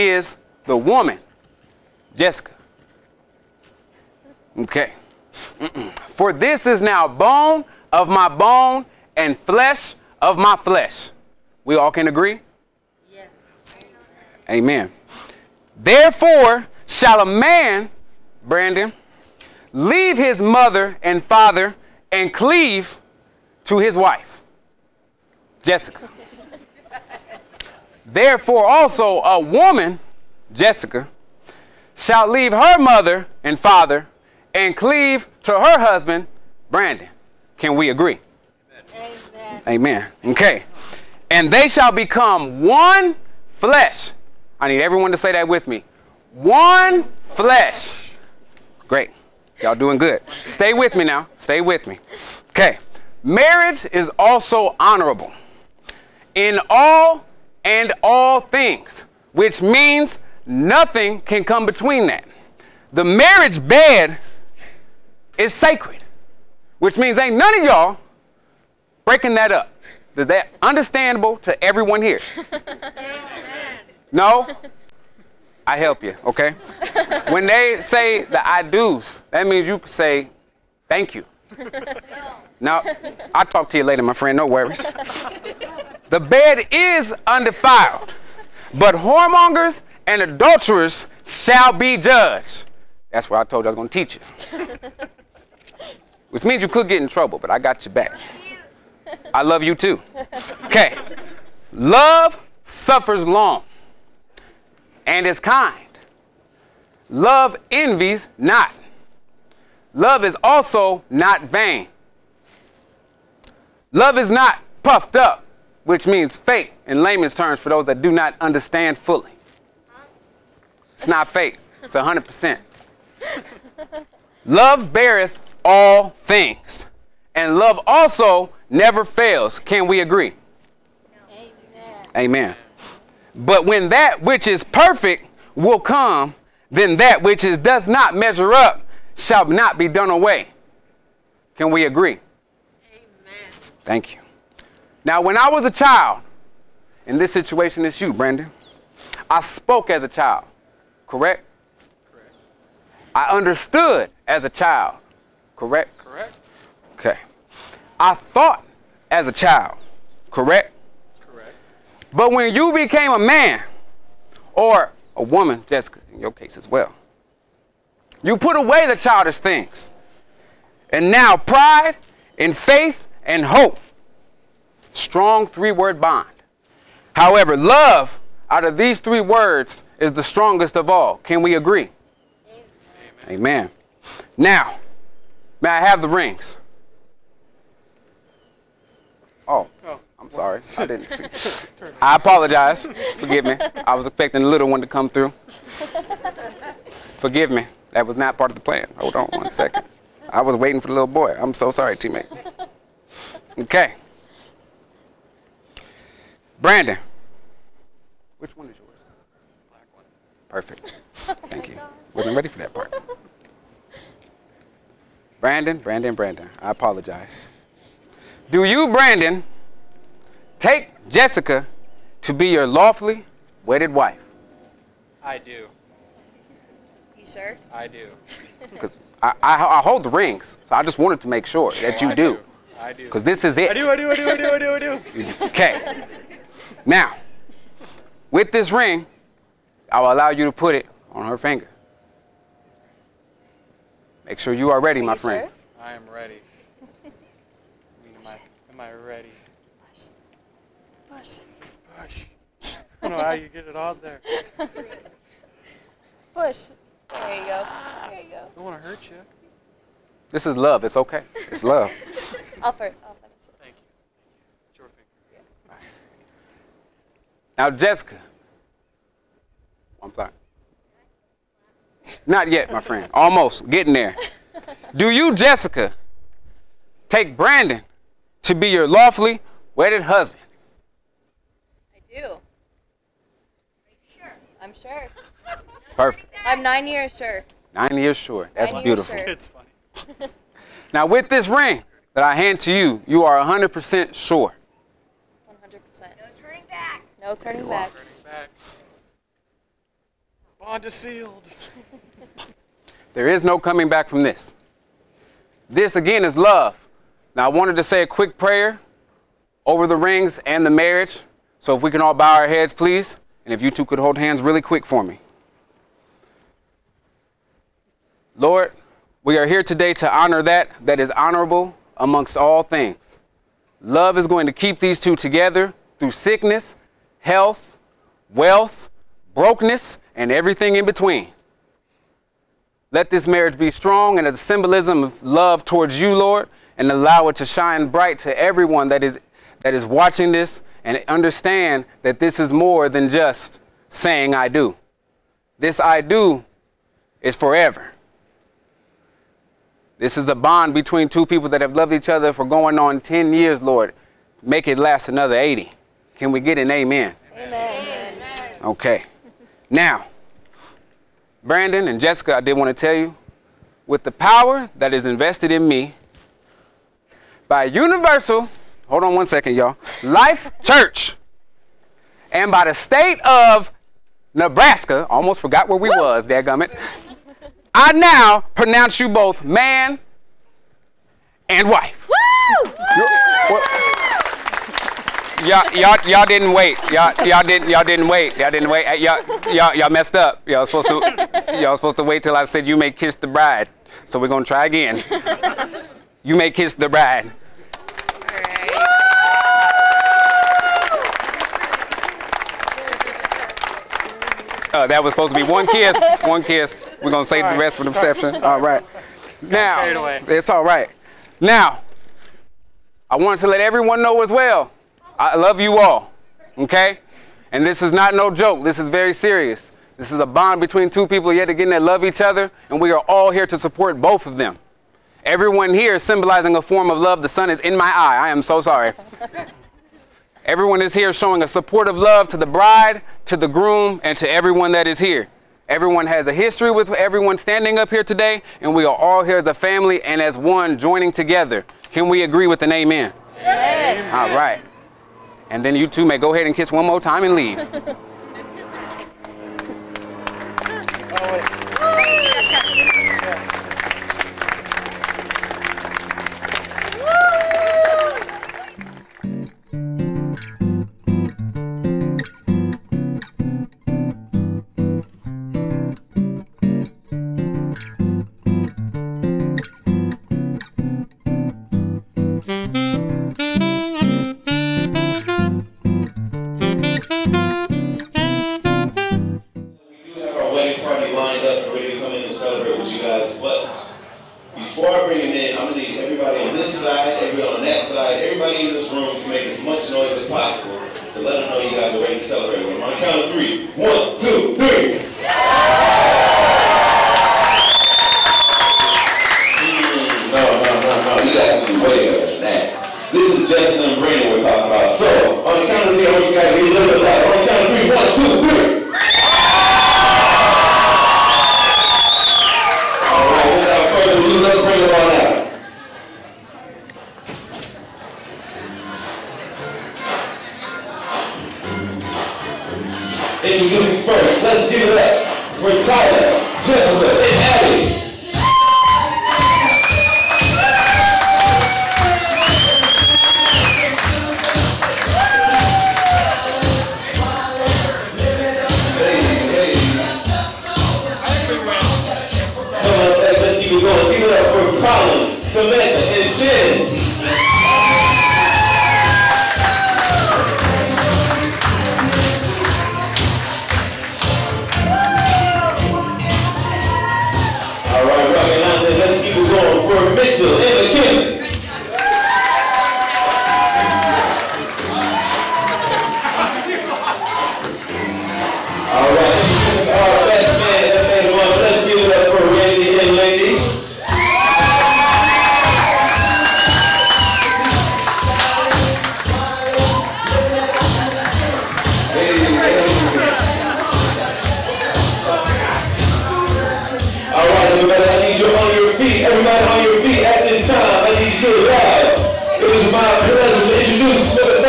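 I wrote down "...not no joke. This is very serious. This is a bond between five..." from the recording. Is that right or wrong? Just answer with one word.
wrong.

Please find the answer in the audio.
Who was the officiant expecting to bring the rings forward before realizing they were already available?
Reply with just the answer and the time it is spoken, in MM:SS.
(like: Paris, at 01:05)
The little boy, at 03:20.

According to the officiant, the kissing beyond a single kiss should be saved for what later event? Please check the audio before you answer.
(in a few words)
The reception.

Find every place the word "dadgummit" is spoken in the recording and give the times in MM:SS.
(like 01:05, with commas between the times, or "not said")
06:16.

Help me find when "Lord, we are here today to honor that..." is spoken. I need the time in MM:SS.
05:18.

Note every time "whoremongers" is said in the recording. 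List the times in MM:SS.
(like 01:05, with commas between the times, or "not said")
01:28.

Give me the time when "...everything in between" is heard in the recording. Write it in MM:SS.
05:30.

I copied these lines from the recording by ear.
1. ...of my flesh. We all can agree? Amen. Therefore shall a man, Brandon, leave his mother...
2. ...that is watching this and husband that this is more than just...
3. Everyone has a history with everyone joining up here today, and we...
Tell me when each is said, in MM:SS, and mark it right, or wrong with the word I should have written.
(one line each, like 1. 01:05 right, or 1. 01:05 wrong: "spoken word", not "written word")
1. 00:10 right
2. 05:39 wrong: "understand", not "husband"
3. 07:15 wrong: "standing", not "joining".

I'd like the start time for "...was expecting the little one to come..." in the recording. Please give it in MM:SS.
03:13.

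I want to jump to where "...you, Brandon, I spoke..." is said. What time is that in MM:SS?
02:27.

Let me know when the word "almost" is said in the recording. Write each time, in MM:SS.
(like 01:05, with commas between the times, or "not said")
04:33, 06:15.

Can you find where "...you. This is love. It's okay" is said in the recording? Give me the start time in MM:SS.
04:19.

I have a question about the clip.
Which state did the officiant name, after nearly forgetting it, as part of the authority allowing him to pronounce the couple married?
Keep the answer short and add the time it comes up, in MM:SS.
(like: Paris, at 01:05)
Nebraska, at 06:12.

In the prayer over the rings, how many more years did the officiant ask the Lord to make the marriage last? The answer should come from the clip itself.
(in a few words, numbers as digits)
80.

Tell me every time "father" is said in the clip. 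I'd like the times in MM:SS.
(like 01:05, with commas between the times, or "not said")
00:21, 00:33.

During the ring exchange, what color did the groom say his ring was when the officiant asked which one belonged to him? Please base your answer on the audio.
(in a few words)
Black.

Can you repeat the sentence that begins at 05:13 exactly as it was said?
And if you two could hold hands really quick for me.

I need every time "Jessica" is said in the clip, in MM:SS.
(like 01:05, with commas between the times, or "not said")
00:02, 00:25, 00:30, 02:45, 03:41, 04:27, 04:35, 06:01.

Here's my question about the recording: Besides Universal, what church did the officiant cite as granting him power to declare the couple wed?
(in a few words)
Life Church.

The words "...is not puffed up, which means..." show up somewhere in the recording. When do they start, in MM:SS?
01:54.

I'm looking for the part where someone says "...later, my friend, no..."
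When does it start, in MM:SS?
01:23.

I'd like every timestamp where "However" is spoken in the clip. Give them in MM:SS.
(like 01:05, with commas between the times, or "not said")
02:57.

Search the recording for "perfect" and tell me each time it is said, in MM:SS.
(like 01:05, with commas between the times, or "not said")
02:14, 03:30, 04:45.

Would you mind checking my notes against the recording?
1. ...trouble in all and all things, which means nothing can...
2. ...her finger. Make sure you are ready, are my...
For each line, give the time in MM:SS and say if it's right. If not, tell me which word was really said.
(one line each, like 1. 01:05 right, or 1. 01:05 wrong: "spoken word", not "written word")
1. 00:54 wrong: "honorable", not "trouble"
2. 04:01 right.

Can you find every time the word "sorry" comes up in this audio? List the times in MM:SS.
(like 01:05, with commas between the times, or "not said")
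03:10, 03:21, 07:08.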